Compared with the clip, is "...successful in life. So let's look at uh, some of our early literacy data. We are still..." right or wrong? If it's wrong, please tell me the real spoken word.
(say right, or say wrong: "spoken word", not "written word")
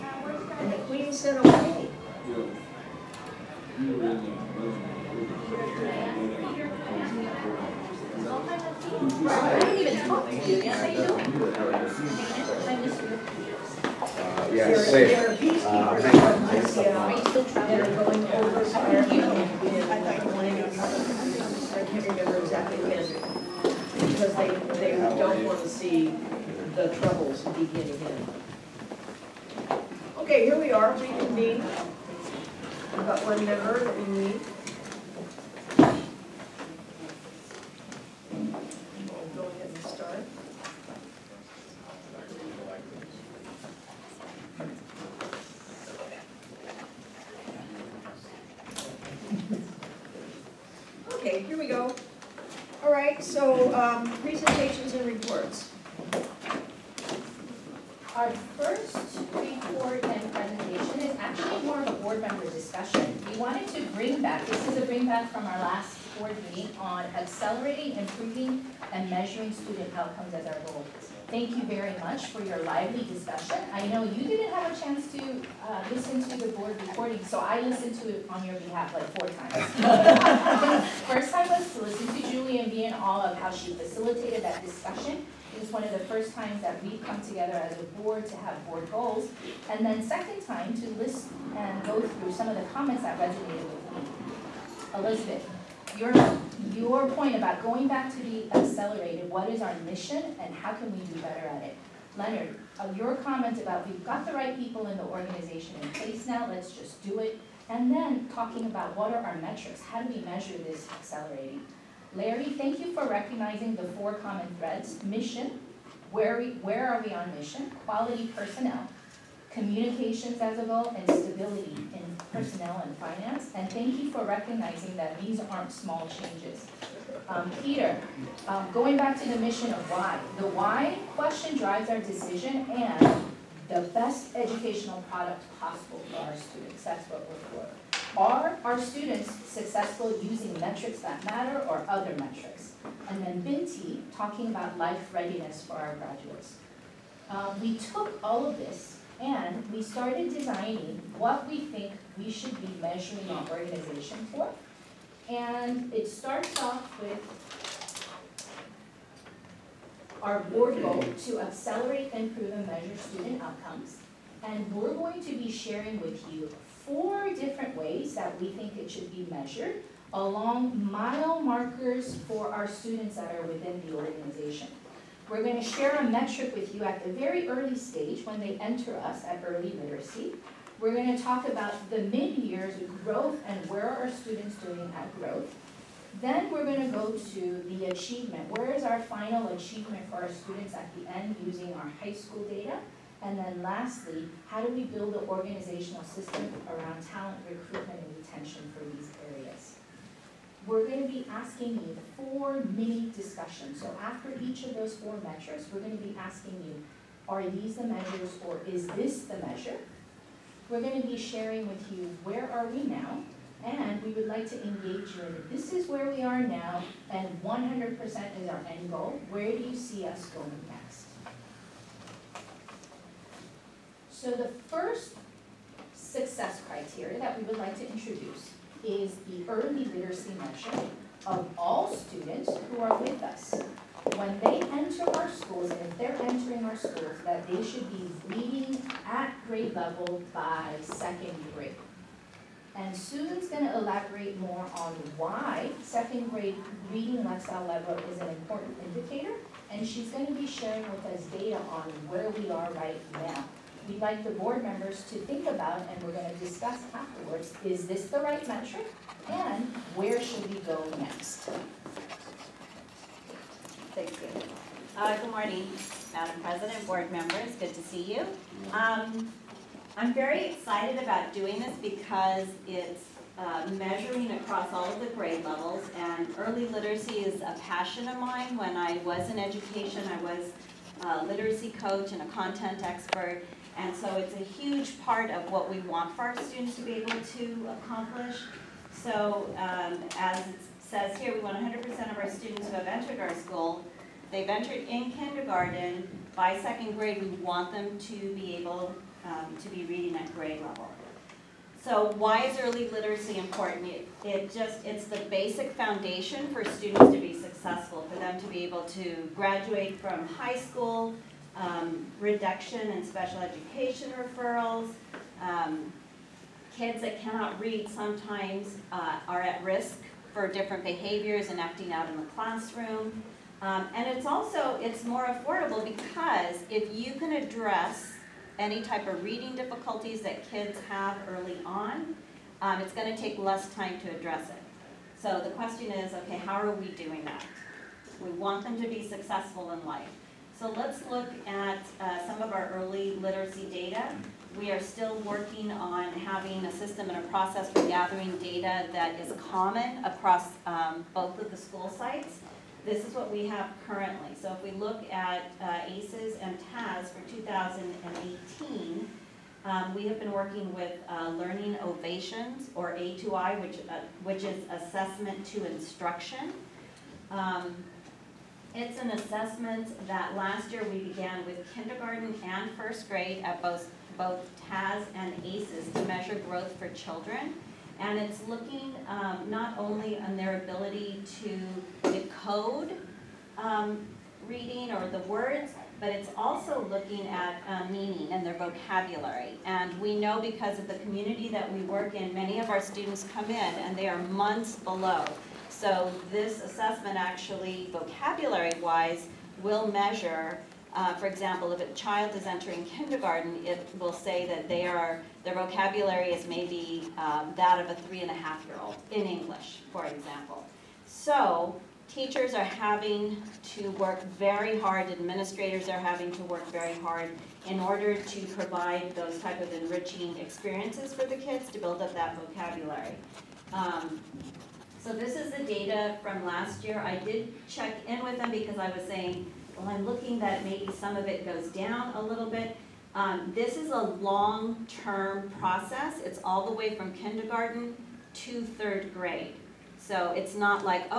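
right.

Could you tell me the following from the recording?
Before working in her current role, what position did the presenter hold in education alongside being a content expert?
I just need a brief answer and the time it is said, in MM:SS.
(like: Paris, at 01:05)
Literacy coach, at 04:41.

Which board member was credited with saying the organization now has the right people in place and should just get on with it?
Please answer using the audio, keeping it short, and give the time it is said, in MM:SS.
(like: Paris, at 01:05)
Leonard, at 01:42.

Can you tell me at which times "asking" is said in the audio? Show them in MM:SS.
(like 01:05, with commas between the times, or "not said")
03:21, 03:26.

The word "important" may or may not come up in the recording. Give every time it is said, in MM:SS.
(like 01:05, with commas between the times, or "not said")
04:08, 05:03.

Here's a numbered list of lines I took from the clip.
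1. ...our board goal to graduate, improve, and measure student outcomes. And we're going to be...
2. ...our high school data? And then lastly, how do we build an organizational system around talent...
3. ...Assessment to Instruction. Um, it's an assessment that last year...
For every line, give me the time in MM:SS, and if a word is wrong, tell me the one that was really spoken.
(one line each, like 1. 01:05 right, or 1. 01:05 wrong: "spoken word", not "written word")
1. 02:40 wrong: "accelerate", not "graduate"
2. 03:11 right
3. 06:04 right.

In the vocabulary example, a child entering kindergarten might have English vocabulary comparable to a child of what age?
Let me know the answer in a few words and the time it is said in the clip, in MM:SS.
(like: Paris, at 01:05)
3 and a half, at 06:48.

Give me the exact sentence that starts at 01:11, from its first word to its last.
Thank you very much for your lively discussion.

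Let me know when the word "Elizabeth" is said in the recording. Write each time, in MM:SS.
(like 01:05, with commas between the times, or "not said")
01:34.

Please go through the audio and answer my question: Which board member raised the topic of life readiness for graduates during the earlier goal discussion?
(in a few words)
Binti.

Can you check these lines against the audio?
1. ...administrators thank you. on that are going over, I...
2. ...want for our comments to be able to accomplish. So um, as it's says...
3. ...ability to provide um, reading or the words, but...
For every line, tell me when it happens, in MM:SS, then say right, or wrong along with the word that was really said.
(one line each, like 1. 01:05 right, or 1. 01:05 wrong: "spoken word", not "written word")
1. 00:15 wrong: "peacekeepers", not "administrators"
2. 04:45 wrong: "students", not "comments"
3. 06:20 wrong: "decode", not "provide".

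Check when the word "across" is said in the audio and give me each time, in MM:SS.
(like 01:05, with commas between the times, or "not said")
04:34, 05:50.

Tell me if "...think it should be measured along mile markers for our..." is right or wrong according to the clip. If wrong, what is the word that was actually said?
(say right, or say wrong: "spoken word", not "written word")
right.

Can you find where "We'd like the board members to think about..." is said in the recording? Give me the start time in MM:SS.
04:13.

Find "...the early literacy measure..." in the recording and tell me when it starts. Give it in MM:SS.
03:49.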